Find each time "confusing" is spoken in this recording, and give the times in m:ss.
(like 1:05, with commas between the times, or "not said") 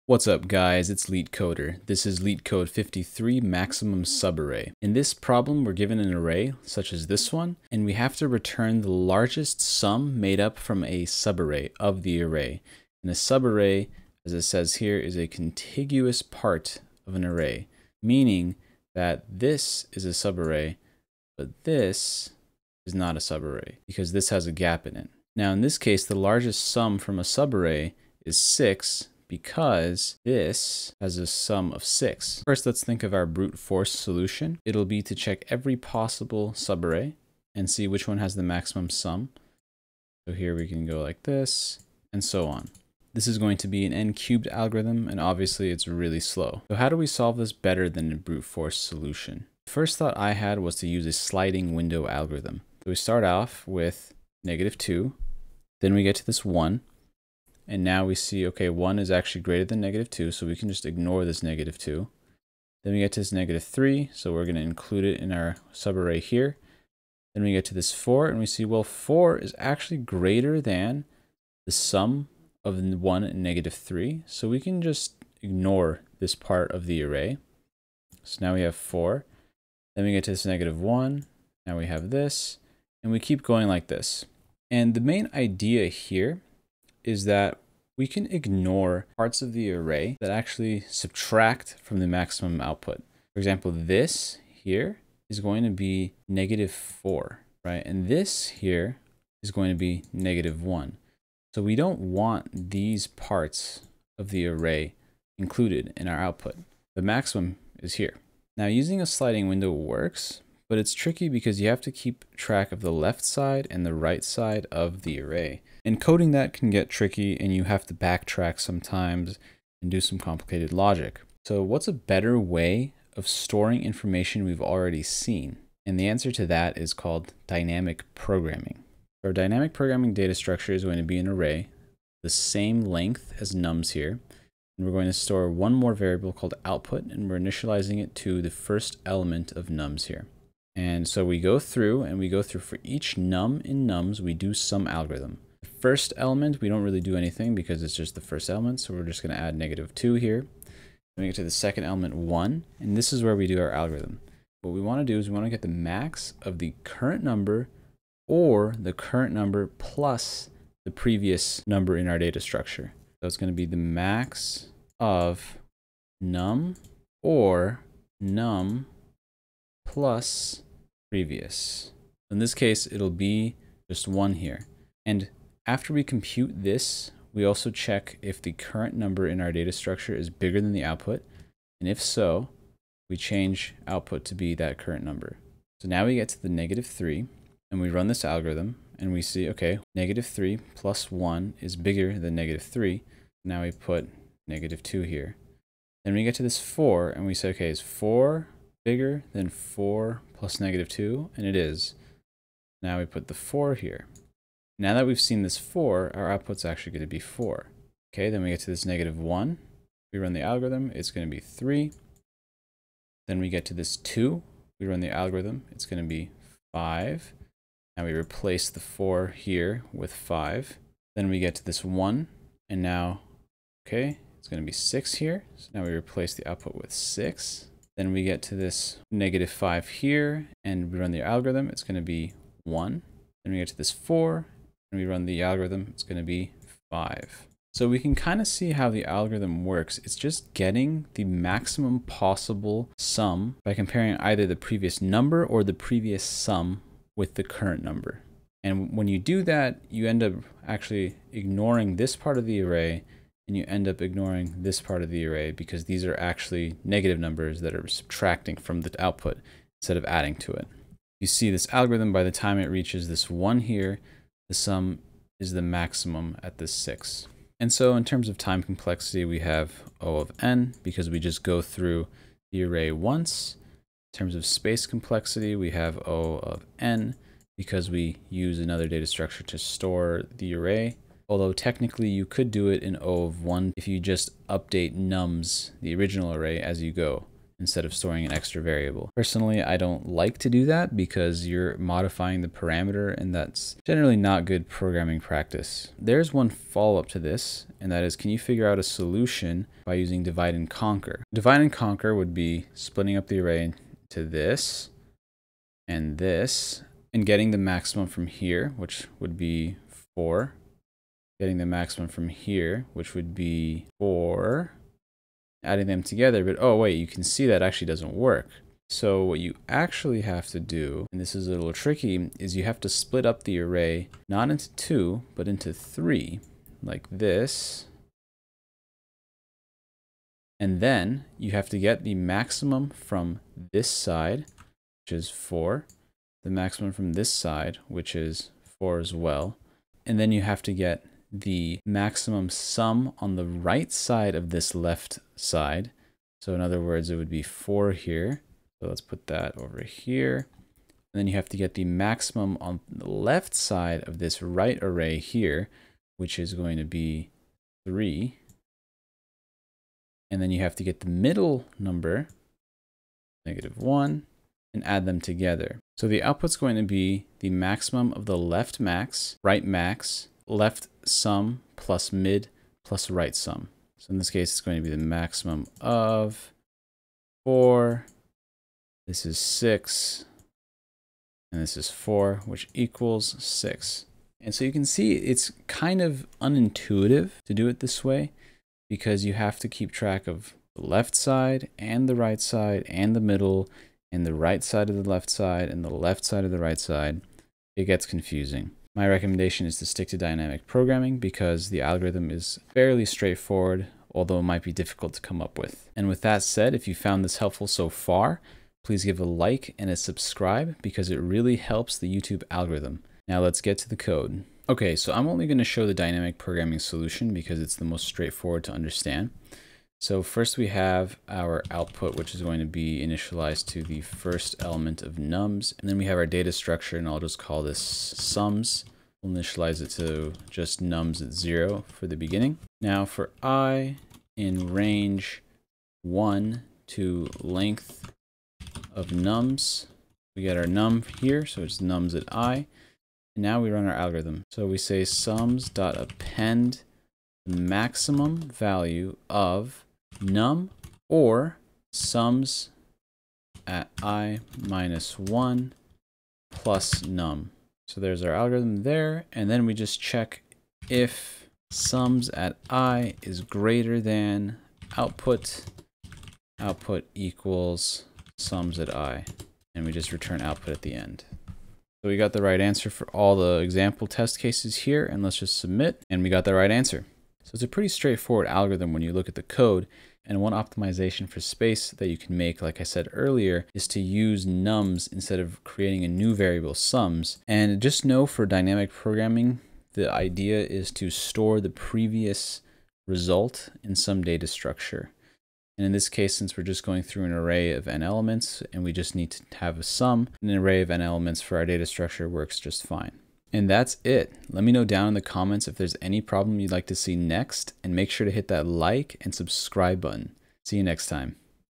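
6:38.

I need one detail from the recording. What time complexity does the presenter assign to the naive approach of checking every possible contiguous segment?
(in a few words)
n-cubed.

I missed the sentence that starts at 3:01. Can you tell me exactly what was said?
And if so, we change output to be that current number.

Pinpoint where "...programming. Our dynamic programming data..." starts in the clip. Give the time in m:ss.
2:08.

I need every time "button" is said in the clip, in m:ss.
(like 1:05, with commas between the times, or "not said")
8:30.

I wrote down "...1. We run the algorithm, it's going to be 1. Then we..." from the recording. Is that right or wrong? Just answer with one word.
wrong.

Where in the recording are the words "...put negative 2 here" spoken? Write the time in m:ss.
3:13.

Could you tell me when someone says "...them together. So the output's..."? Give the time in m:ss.
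6:05.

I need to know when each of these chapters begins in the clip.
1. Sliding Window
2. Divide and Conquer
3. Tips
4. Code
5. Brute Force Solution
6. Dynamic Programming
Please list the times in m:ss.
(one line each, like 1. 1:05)
1. 0:49
2. 4:55
3. 7:57
4. 6:54
5. 0:33
6. 2:08.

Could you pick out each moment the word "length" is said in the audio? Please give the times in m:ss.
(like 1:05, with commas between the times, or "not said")
2:12, 7:17.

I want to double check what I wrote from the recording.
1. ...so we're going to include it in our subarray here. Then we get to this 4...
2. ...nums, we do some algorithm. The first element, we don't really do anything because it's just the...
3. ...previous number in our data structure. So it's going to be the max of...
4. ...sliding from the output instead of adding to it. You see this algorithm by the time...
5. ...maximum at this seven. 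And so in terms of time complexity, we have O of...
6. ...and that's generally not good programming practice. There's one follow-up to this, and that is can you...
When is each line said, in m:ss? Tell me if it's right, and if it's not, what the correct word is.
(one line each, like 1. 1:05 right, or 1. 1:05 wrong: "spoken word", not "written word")
1. 1:04 right
2. 2:23 right
3. 2:40 right
4. 4:17 wrong: "subtracting", not "sliding"
5. 4:25 wrong: "six", not "seven"
6. 4:53 right.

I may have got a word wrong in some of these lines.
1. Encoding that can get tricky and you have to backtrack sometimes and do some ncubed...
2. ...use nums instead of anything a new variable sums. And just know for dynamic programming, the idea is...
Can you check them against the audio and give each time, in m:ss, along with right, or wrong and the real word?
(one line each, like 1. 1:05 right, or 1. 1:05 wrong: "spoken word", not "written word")
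1. 1:55 wrong: "complicated", not "ncubed"
2. 8:03 wrong: "creating", not "anything".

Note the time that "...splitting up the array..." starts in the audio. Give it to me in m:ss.
5:02.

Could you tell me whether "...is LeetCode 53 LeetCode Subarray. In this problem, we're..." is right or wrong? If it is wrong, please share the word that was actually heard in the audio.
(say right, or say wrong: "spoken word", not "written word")
wrong: "Maximum", not "LeetCode".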